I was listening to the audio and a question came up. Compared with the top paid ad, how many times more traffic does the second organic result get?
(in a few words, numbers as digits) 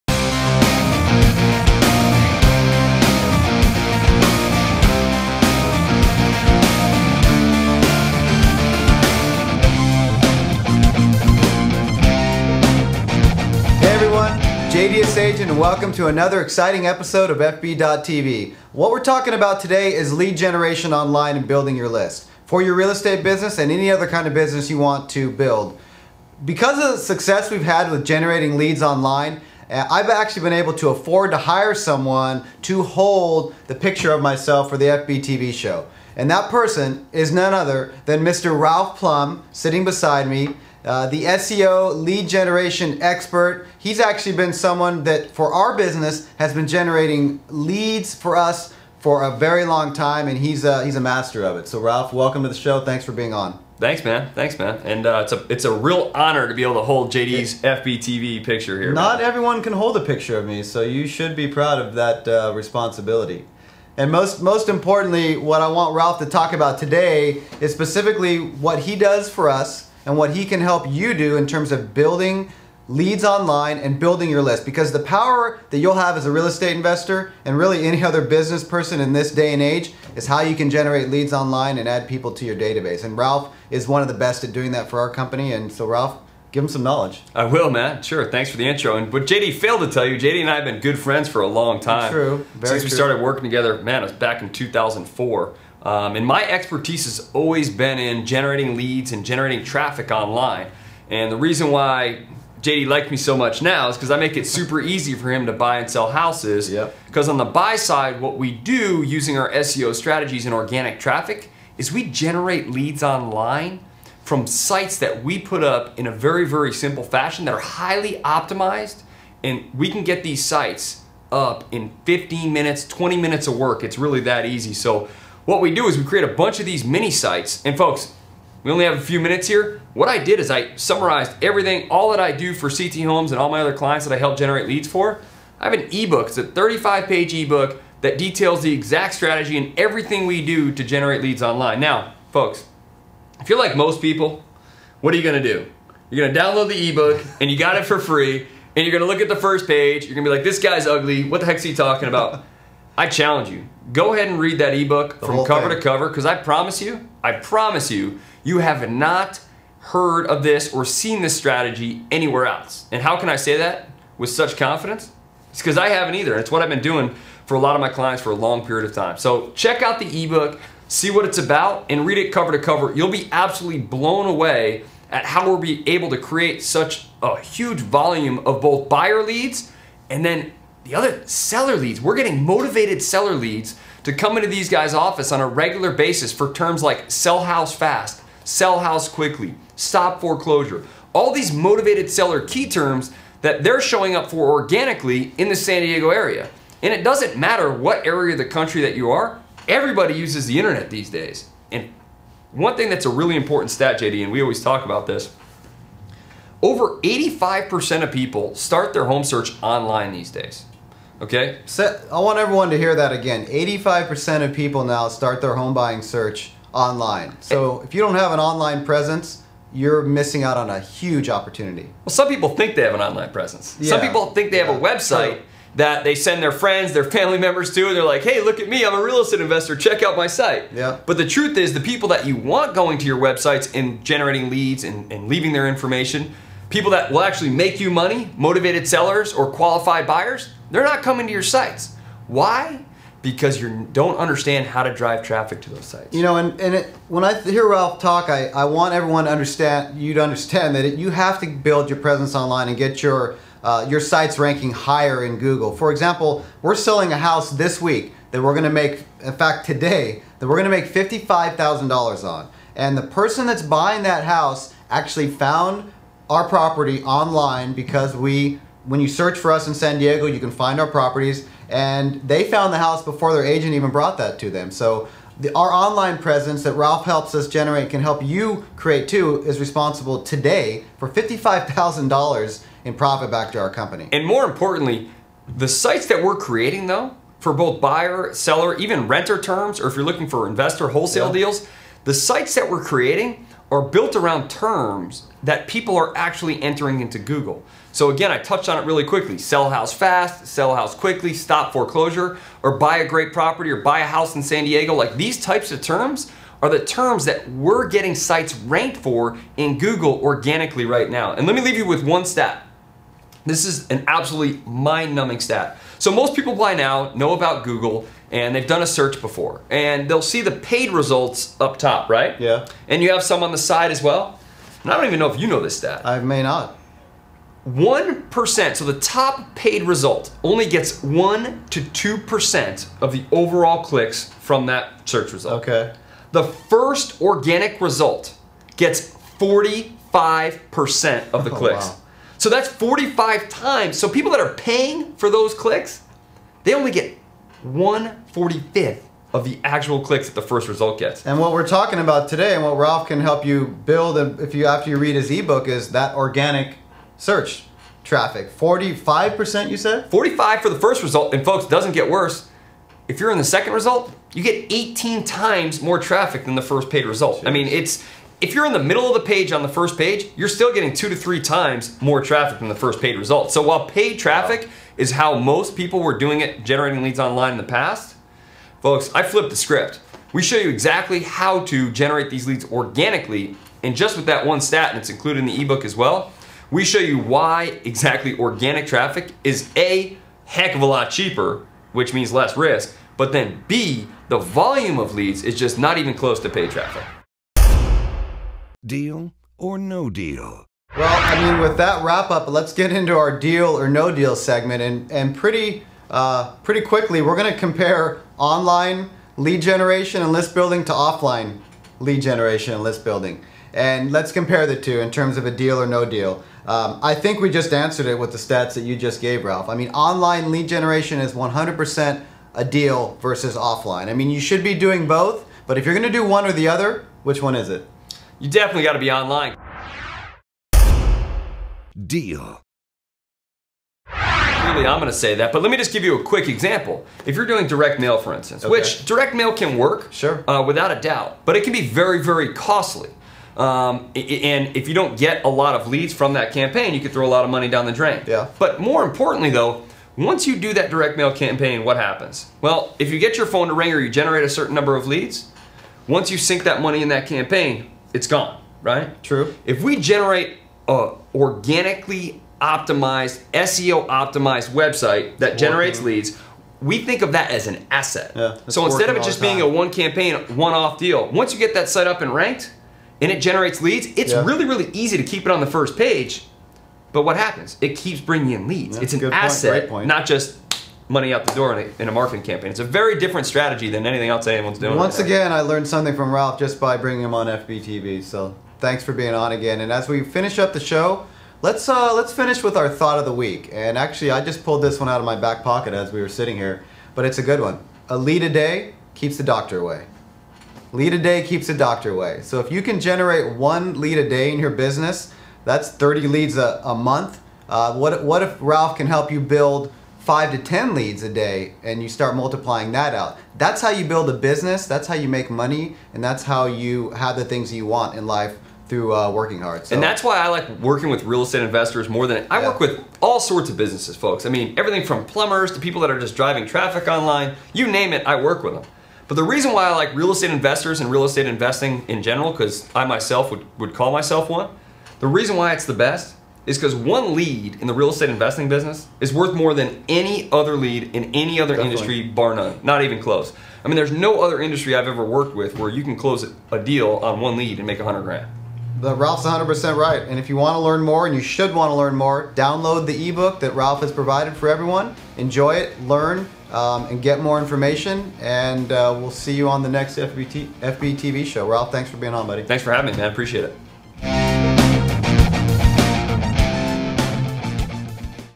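18.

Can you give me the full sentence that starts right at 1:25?
And so, Ralph, give him some knowledge.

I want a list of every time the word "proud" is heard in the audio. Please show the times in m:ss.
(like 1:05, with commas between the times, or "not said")
1:01.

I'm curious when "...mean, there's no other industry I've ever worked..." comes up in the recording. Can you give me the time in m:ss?
9:03.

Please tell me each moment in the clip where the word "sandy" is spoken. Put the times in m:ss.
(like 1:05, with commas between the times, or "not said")
not said.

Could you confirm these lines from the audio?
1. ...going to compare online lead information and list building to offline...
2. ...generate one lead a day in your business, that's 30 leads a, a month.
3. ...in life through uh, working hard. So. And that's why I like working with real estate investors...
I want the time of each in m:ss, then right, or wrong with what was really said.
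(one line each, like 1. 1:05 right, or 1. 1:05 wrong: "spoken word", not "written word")
1. 6:47 wrong: "generation", not "information"
2. 8:23 right
3. 8:38 right.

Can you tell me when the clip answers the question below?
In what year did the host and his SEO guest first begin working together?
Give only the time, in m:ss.
1:34.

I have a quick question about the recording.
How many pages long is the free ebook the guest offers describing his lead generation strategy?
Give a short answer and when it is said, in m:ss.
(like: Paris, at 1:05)
35, at 2:16.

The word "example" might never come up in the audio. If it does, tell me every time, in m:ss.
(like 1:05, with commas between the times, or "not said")
4:15, 7:16.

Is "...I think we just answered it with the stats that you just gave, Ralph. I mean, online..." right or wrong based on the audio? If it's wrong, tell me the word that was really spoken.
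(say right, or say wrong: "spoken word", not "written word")
right.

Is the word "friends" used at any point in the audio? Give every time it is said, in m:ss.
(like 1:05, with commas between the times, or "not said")
1:30, 3:46.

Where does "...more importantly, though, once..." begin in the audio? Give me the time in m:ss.
7:28.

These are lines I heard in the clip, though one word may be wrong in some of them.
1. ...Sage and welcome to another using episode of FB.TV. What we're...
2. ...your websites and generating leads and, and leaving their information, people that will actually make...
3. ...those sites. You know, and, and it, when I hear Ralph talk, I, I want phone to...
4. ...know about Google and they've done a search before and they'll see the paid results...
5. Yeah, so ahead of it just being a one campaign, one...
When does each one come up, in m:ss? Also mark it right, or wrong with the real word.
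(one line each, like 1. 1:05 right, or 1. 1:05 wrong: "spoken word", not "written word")
1. 0:15 wrong: "exciting", not "using"
2. 3:53 right
3. 4:05 wrong: "everyone", not "phone"
4. 5:17 right
5. 7:48 wrong: "instead", not "ahead".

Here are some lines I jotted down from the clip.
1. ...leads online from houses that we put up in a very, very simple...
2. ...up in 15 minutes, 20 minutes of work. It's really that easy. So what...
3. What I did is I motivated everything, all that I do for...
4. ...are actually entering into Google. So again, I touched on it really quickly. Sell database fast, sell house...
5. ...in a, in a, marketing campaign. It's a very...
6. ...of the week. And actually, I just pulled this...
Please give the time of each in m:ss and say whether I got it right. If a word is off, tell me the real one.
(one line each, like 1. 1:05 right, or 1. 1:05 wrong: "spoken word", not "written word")
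1. 1:52 wrong: "sites", not "houses"
2. 2:01 right
3. 2:09 wrong: "summarized", not "motivated"
4. 4:55 wrong: "house", not "database"
5. 8:01 right
6. 8:13 right.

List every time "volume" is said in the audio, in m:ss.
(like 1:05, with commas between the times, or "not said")
2:57, 6:34.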